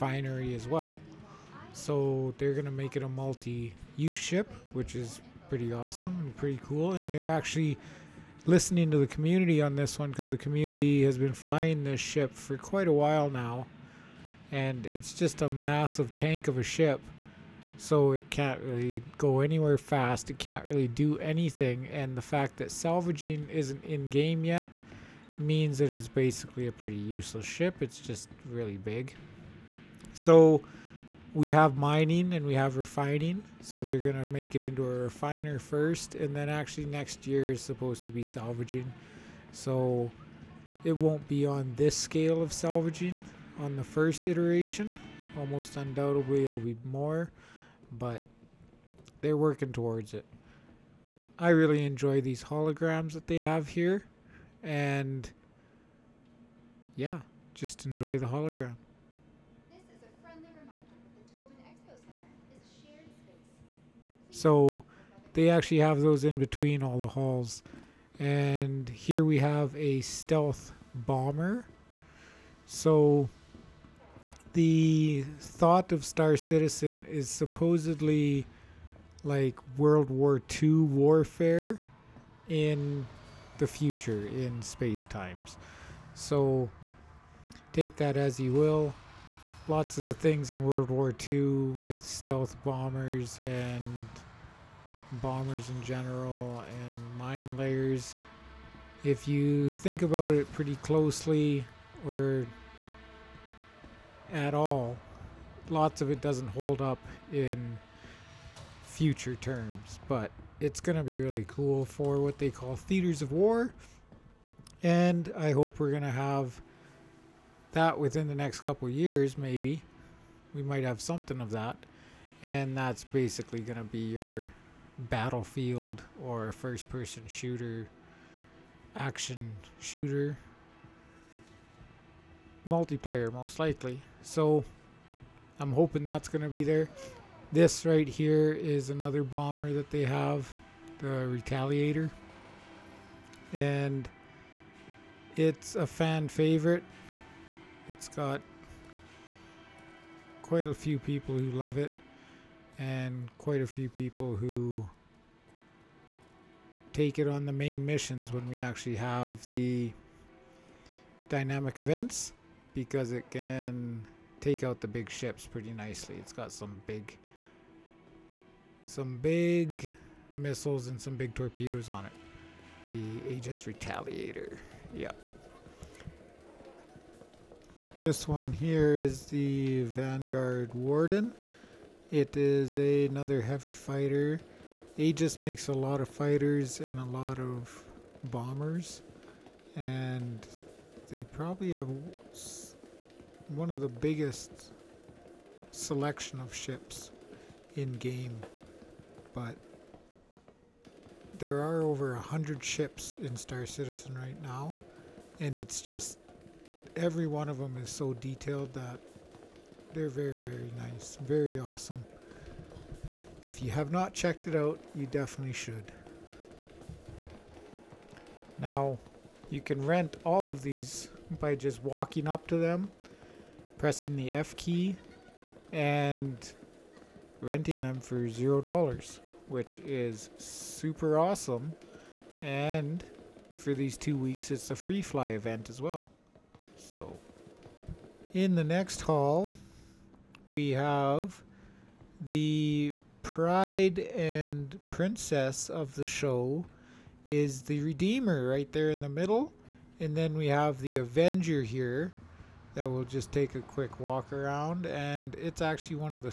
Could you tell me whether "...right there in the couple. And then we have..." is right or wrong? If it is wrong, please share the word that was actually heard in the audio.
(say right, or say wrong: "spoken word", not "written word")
wrong: "middle", not "couple".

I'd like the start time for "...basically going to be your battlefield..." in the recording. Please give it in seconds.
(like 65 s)
123 s.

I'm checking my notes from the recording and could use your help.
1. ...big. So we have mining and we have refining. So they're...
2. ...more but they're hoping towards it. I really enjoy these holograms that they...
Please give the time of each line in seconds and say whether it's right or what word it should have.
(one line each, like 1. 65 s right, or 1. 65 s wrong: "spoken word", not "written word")
1. 28 s right
2. 46 s wrong: "working", not "hoping".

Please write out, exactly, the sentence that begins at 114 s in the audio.
And I hope we're going to have that within the next couple years, maybe.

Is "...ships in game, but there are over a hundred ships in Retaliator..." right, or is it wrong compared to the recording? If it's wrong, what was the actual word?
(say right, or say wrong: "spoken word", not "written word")
wrong: "Star", not "Retaliator".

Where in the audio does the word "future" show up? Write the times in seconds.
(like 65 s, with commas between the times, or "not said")
83 s, 108 s.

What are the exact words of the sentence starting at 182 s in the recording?
It is a, another heavy fighter.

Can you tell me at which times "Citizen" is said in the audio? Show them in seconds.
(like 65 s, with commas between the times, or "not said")
76 s, 203 s.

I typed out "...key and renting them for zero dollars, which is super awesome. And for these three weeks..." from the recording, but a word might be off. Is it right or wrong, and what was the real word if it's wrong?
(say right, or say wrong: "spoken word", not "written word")
wrong: "two", not "three".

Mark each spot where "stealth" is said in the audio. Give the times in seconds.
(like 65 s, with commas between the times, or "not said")
70 s, 92 s.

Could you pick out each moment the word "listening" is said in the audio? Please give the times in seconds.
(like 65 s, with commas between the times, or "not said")
8 s.